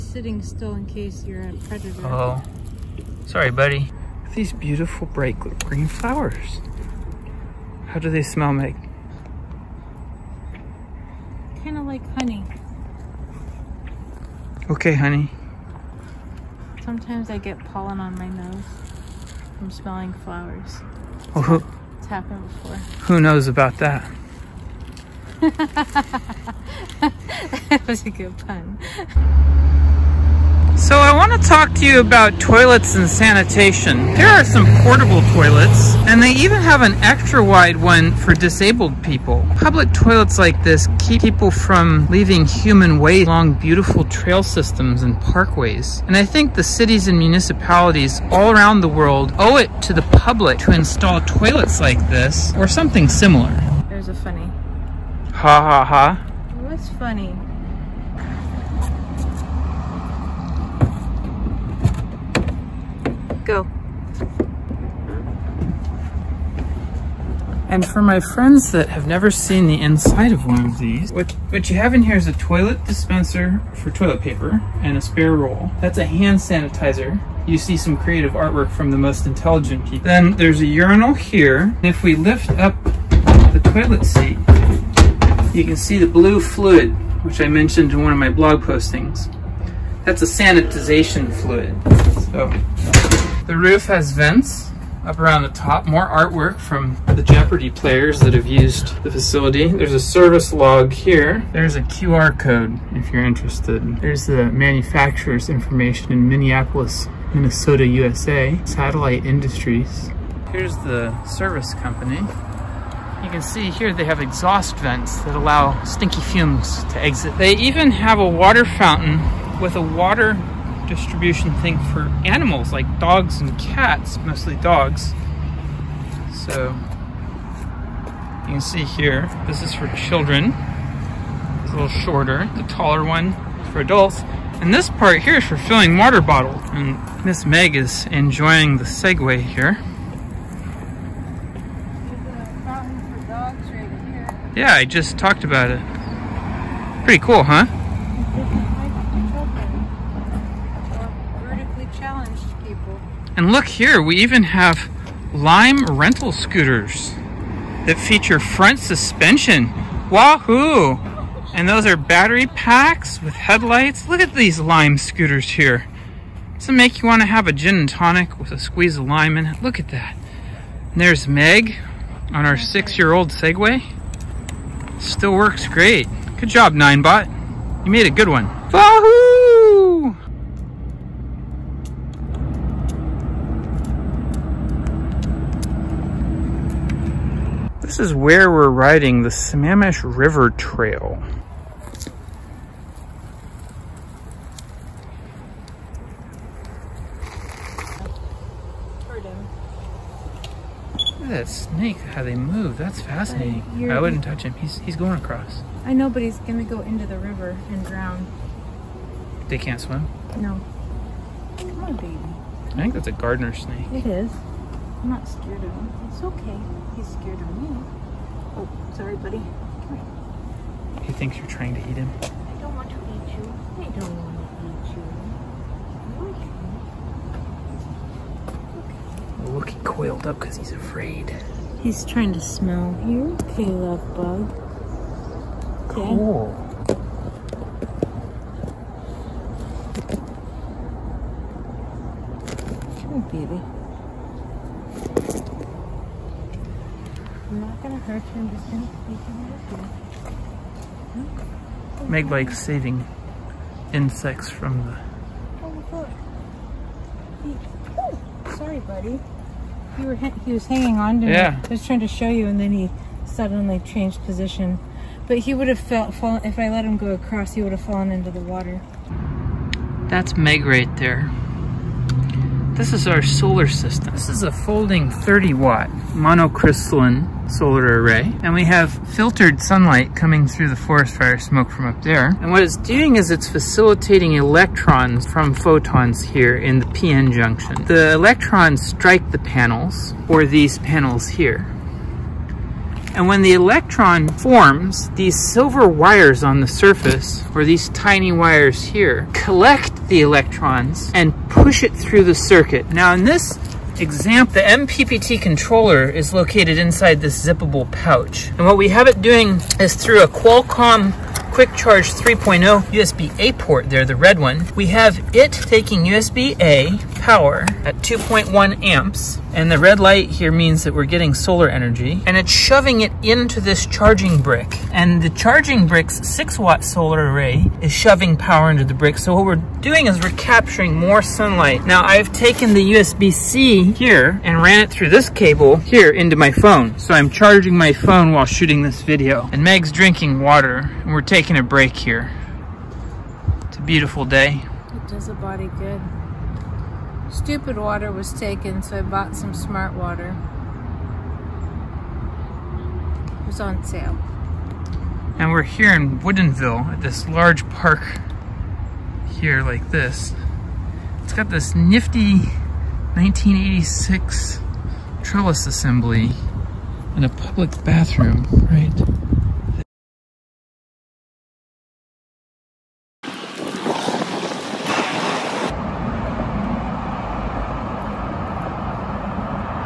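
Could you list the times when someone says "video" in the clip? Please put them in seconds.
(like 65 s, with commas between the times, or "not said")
339 s.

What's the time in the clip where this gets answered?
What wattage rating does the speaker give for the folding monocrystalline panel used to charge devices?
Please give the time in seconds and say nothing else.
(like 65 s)
275 s.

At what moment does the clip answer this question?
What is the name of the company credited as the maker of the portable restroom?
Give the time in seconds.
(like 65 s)
108 s.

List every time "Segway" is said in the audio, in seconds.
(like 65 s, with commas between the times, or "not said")
138 s, 173 s.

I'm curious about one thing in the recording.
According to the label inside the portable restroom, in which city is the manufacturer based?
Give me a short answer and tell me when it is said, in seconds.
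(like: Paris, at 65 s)
Minneapolis, at 106 s.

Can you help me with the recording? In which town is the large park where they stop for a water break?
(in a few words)
Woodinville.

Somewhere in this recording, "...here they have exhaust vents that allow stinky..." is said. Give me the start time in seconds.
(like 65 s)
113 s.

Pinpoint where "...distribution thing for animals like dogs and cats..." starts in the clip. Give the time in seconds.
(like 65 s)
120 s.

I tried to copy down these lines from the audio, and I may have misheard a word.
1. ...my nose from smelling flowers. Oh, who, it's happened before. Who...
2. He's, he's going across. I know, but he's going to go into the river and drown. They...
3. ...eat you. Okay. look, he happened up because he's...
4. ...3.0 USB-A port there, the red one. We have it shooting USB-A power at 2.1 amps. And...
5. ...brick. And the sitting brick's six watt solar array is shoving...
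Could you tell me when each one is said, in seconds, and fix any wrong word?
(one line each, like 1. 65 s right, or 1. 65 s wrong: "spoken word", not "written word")
1. 18 s right
2. 204 s right
3. 226 s wrong: "coiled", not "happened"
4. 312 s wrong: "taking", not "shooting"
5. 324 s wrong: "charging", not "sitting".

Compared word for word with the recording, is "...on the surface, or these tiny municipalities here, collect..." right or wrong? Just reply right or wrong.
wrong.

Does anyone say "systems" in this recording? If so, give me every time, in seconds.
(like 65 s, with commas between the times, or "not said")
44 s, 273 s.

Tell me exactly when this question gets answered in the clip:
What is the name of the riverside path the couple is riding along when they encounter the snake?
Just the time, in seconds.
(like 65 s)
189 s.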